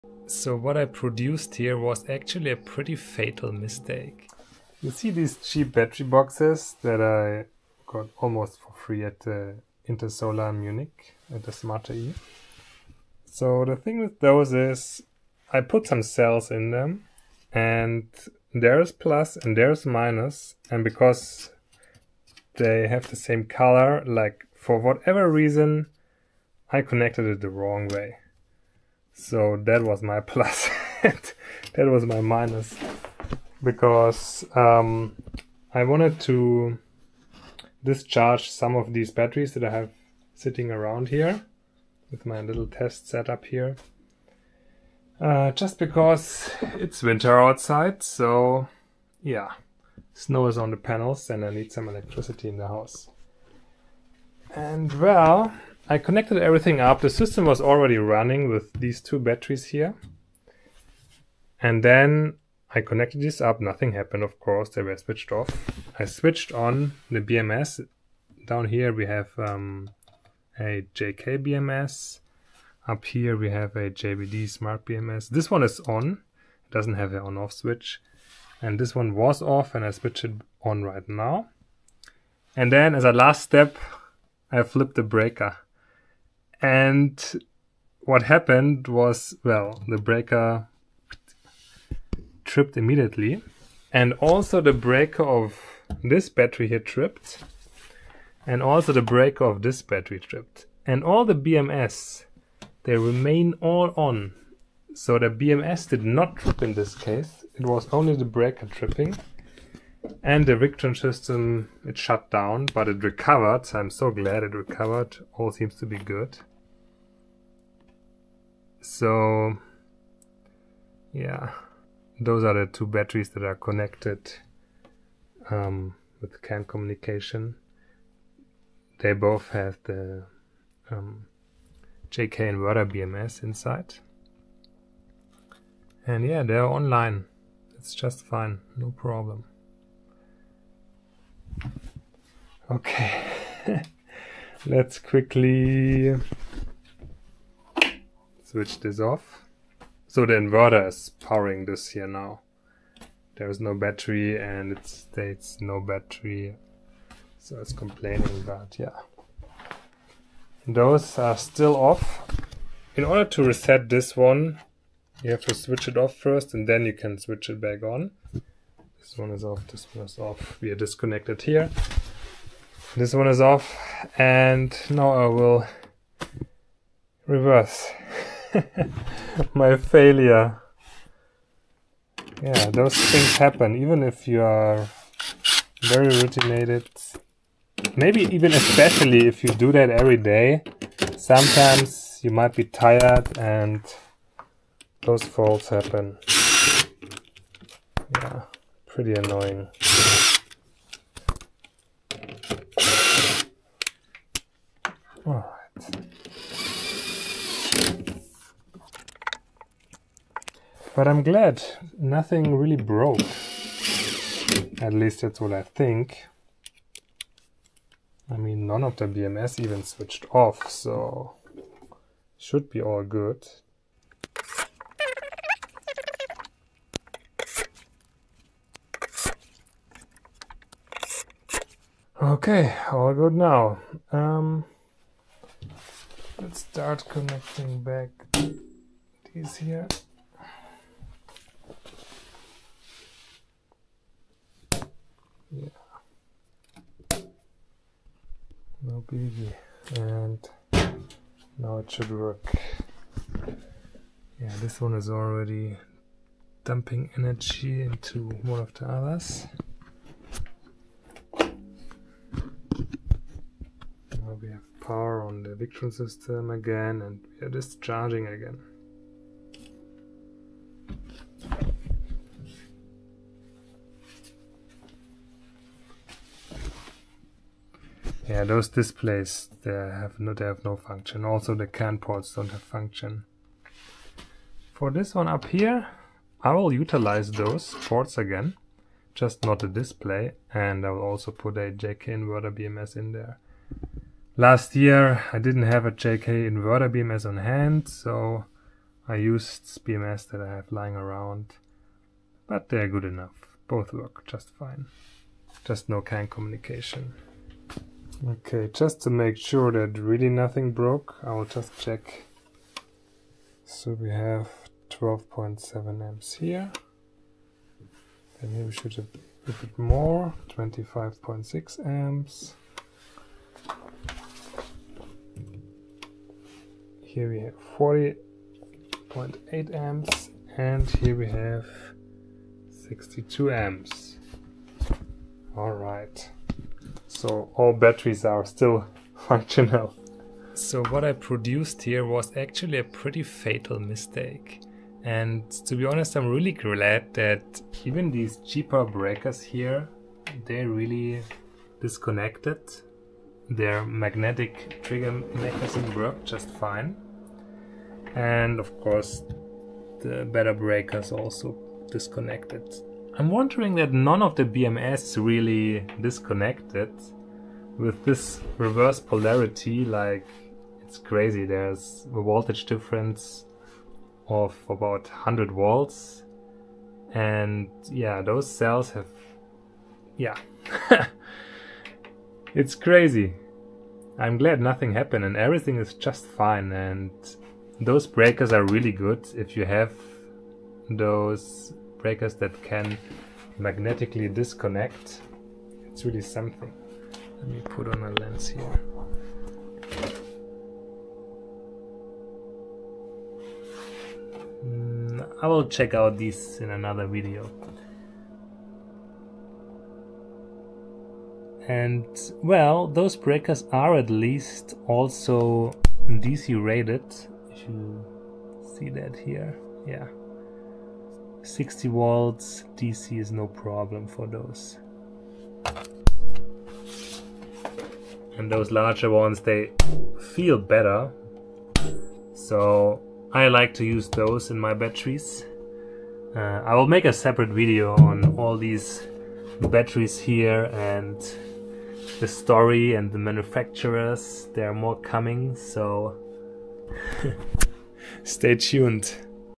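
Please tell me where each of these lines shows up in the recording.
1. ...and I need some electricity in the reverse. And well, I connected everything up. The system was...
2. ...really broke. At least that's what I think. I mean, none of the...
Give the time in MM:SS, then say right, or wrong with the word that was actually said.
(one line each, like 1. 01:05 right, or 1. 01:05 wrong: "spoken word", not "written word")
1. 00:51 wrong: "house", not "reverse"
2. 03:32 right.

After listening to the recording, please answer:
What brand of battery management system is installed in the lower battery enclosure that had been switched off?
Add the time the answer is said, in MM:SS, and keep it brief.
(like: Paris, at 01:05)
JK BMS, at 01:10.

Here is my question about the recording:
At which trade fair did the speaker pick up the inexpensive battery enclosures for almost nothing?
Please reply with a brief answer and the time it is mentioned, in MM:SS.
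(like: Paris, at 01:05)
Intersolar Munich, at 00:09.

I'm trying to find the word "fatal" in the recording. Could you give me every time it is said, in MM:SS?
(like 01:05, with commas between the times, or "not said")
00:02, 05:43.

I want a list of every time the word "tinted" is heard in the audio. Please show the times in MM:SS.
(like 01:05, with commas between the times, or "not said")
not said.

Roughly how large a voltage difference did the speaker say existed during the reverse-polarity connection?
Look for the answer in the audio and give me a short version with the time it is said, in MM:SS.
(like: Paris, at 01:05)
100 volts, at 06:15.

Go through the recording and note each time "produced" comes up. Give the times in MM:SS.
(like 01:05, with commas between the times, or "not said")
00:00, 05:41.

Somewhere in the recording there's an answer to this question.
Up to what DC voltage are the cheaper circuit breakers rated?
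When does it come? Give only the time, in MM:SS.
07:01.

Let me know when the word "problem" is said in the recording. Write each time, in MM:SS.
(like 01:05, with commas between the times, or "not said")
02:18, 07:03.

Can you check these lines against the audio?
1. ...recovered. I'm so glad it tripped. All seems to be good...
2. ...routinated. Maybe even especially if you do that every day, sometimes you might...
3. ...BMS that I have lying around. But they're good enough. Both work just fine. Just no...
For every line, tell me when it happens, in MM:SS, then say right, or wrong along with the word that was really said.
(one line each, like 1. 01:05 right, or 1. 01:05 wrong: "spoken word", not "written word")
1. 01:53 wrong: "recovered", not "tripped"
2. 03:06 right
3. 04:59 right.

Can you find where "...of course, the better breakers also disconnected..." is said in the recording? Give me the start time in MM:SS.
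05:58.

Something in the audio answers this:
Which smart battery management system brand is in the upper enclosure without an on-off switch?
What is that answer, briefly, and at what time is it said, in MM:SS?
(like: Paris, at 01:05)
JBD, at 01:13.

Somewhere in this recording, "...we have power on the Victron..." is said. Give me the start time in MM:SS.
04:24.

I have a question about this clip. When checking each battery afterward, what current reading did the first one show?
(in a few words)
12.7 amps.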